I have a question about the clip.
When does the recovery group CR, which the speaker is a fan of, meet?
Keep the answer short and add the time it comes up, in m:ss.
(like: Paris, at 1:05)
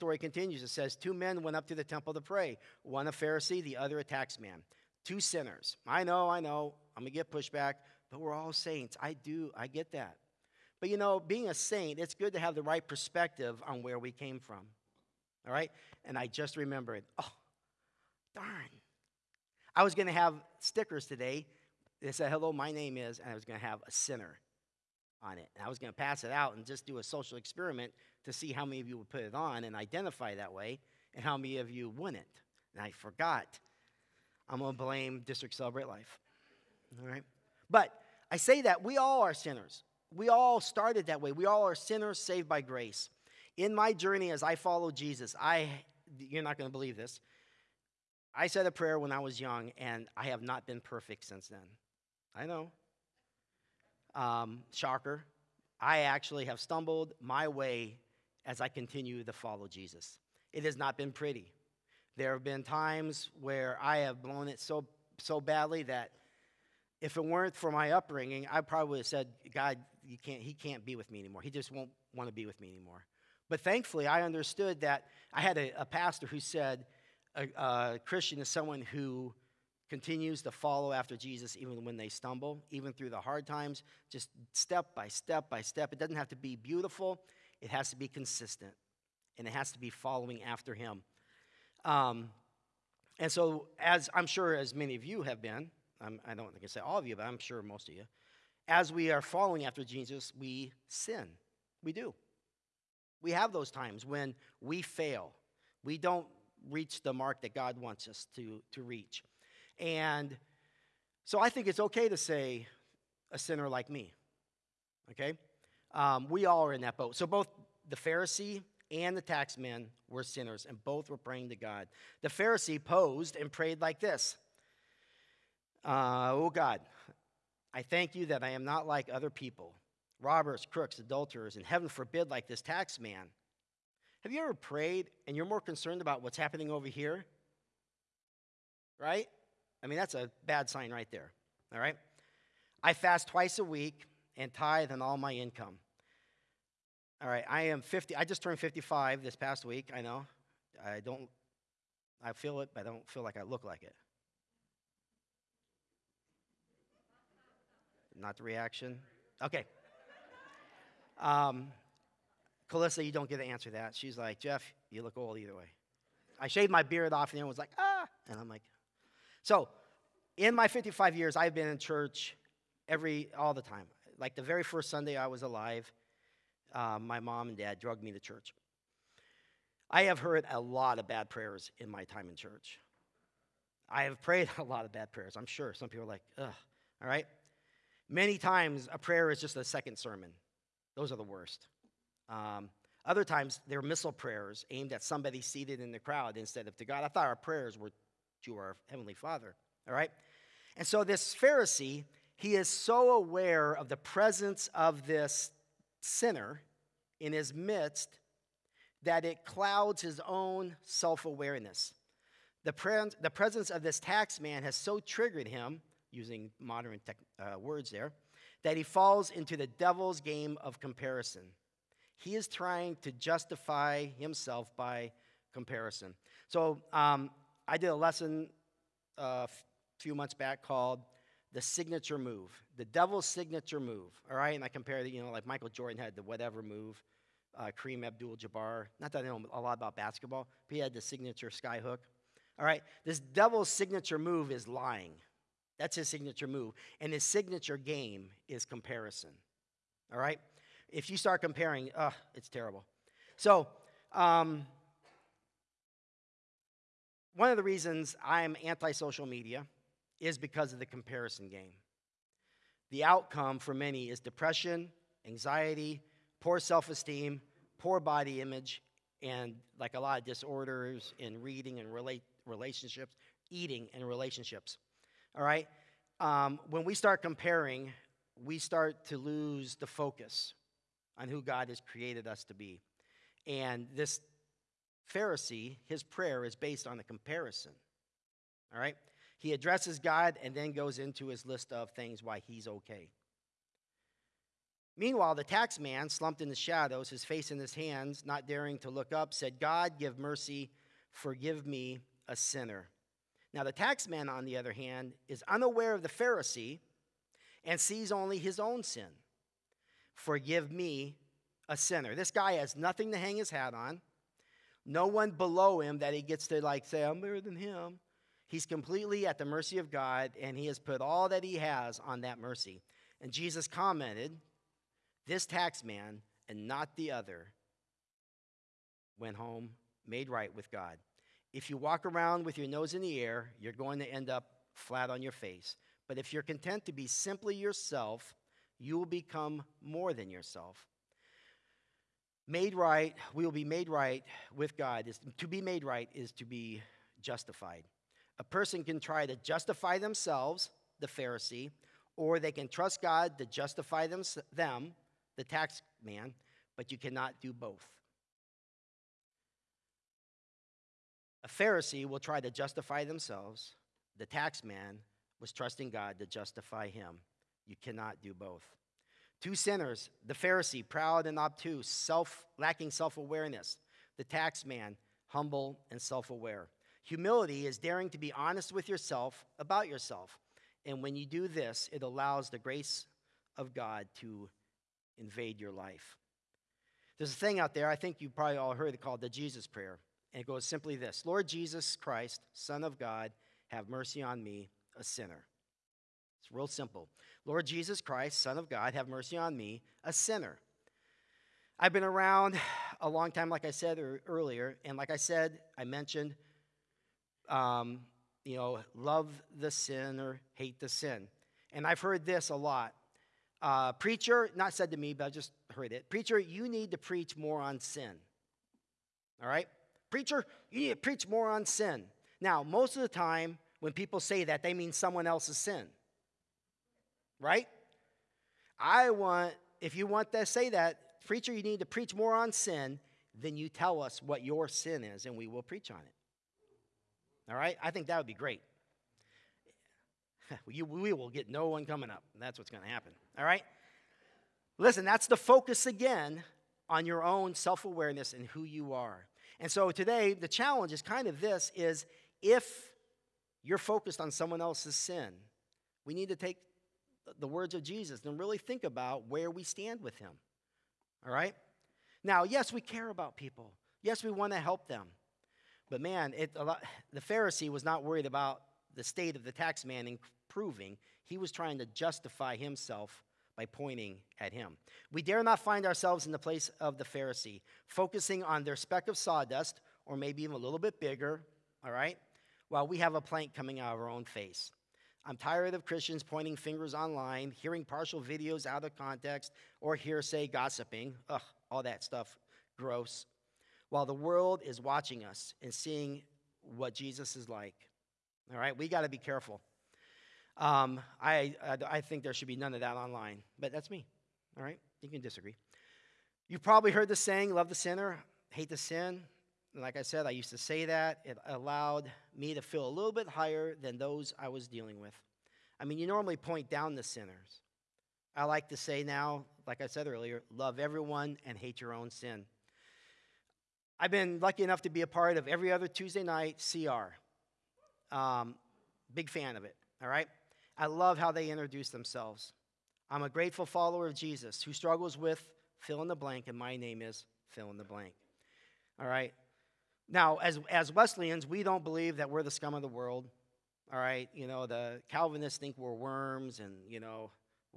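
Every other Tuesday, at 8:45.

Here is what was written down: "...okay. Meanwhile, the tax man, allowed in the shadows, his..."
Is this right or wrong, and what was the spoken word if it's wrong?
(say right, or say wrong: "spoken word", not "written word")
wrong: "slumped", not "allowed".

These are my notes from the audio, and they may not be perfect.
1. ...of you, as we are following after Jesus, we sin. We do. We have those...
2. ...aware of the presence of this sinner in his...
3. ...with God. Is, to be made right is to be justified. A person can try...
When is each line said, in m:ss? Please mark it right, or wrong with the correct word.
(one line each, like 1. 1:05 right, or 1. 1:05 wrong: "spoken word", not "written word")
1. 1:37 right
2. 3:23 right
3. 5:44 right.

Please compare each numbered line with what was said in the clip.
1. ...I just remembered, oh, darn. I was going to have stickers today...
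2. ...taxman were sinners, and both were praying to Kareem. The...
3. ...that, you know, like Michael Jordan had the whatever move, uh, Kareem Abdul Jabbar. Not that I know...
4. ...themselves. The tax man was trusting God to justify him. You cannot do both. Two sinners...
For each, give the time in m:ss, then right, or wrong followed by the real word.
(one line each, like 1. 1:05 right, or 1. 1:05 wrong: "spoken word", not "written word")
1. 0:16 right
2. 1:59 wrong: "God", not "Kareem"
3. 3:55 right
4. 6:03 right.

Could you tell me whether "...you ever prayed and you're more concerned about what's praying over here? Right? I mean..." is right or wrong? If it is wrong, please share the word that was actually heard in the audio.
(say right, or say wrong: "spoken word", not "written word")
wrong: "happening", not "praying".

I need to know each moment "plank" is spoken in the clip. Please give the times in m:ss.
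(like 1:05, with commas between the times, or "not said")
8:03.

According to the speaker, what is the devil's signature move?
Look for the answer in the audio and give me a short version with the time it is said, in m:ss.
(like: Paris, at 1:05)
Lying, at 4:04.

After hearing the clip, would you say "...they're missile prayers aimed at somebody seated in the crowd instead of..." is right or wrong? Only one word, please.
right.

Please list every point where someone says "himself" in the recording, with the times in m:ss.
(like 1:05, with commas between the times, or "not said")
3:44, 7:52.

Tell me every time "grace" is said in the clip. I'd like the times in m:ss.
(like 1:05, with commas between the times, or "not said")
0:42, 6:22.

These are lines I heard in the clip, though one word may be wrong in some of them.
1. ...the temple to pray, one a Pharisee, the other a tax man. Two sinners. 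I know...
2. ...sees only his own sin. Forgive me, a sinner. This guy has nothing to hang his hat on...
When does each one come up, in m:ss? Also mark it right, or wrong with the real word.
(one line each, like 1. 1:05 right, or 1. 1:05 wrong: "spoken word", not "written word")
1. 0:01 right
2. 5:07 right.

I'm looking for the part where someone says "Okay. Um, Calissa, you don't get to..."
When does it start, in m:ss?
2:39.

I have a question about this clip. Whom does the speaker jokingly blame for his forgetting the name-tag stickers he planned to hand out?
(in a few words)
District Celebrate Life.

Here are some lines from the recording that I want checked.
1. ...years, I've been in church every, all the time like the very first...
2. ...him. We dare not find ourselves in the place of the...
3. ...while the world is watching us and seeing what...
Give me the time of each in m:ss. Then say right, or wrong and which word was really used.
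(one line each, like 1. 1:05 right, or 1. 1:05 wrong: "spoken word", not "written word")
1. 2:51 right
2. 7:54 right
3. 8:13 right.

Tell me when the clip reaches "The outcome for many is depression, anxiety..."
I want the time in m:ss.
4:22.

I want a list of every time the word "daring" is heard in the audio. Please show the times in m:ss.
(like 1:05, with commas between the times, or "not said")
4:58, 6:17.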